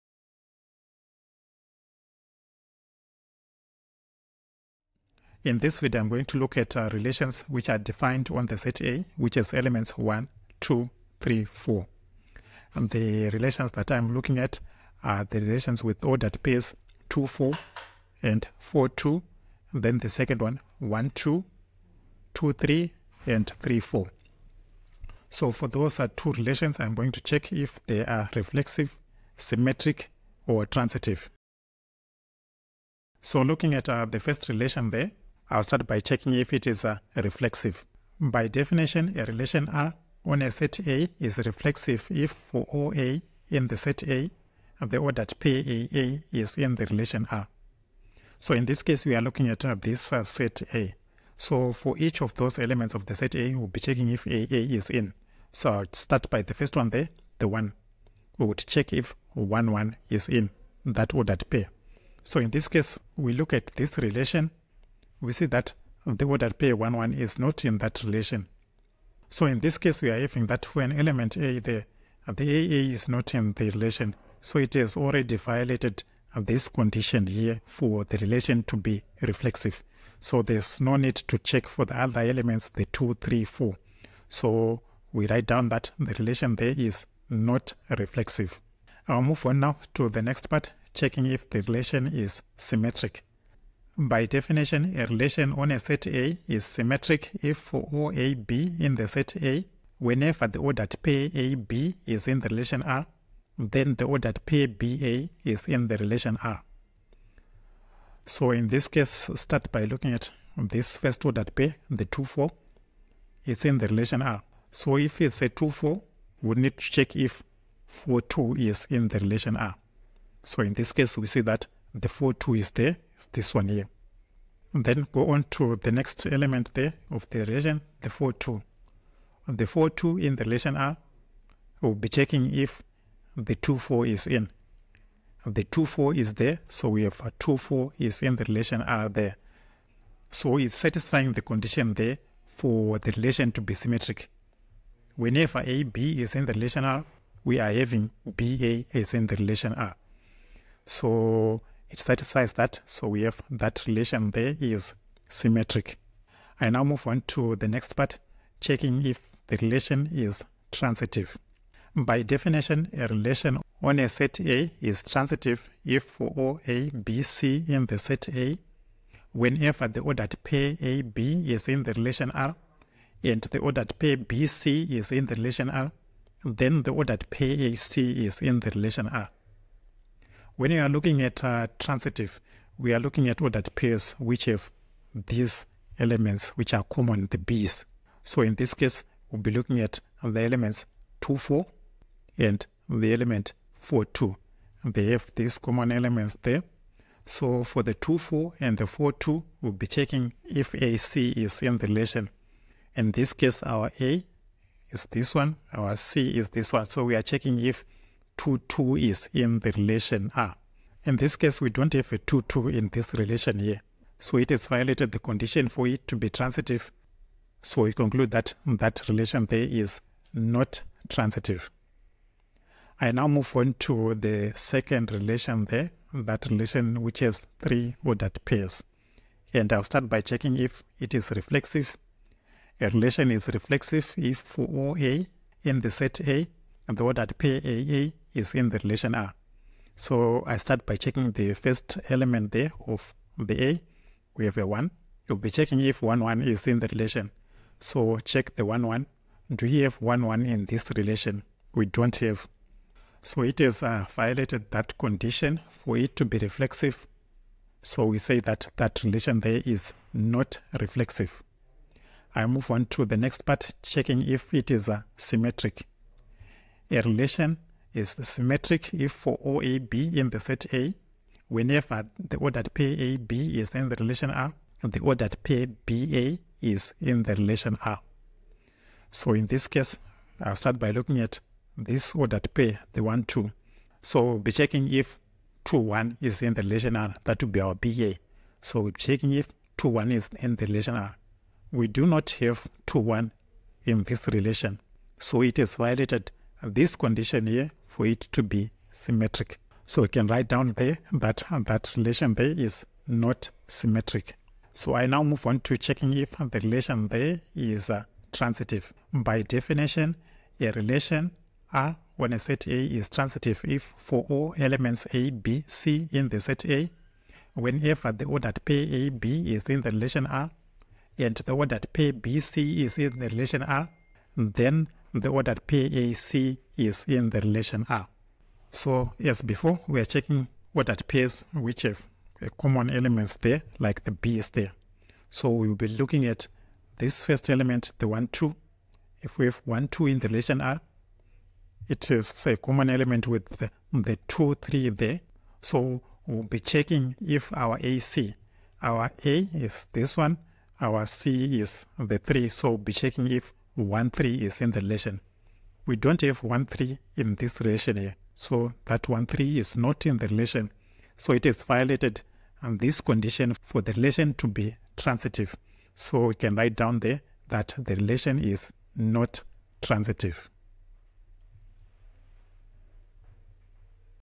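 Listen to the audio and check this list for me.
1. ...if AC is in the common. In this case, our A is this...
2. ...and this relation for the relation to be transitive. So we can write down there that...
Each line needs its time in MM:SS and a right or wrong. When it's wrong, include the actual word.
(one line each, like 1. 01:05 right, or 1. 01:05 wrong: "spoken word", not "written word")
1. 03:20 wrong: "relation", not "common"
2. 06:02 wrong: "condition", not "relation".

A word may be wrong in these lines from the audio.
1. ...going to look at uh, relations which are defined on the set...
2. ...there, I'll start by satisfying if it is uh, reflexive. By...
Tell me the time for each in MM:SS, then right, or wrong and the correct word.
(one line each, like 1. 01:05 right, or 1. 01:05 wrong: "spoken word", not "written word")
1. 00:06 right
2. 00:34 wrong: "checking", not "satisfying".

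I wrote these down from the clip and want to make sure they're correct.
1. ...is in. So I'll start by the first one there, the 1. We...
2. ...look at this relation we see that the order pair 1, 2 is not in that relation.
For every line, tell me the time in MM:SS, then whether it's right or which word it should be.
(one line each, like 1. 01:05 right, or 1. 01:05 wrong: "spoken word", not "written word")
1. 00:54 right
2. 01:03 wrong: "1", not "2".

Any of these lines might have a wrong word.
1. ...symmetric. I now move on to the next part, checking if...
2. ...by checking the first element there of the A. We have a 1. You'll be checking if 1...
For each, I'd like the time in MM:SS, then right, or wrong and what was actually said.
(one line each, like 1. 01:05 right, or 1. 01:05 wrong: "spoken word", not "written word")
1. 02:35 right
2. 04:00 right.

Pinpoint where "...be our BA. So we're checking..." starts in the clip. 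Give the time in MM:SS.
04:47.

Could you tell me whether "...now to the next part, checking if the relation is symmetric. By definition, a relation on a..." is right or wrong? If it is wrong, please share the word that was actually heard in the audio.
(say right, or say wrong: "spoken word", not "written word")
right.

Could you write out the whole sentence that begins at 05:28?
So as before, we are checking order pairs which have a common elements there, like the B is there.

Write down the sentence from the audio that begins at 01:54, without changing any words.
So if it's a 2, 4, we need to check if 4, 2 is in the relation R.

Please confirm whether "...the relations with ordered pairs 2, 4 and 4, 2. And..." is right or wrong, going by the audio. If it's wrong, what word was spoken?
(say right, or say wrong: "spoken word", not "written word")
right.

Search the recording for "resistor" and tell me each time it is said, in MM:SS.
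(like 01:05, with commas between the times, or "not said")
not said.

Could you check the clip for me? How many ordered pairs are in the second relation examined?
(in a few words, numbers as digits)
3.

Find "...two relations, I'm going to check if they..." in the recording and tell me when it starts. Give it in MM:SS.
00:26.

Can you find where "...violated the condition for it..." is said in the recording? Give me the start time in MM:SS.
03:34.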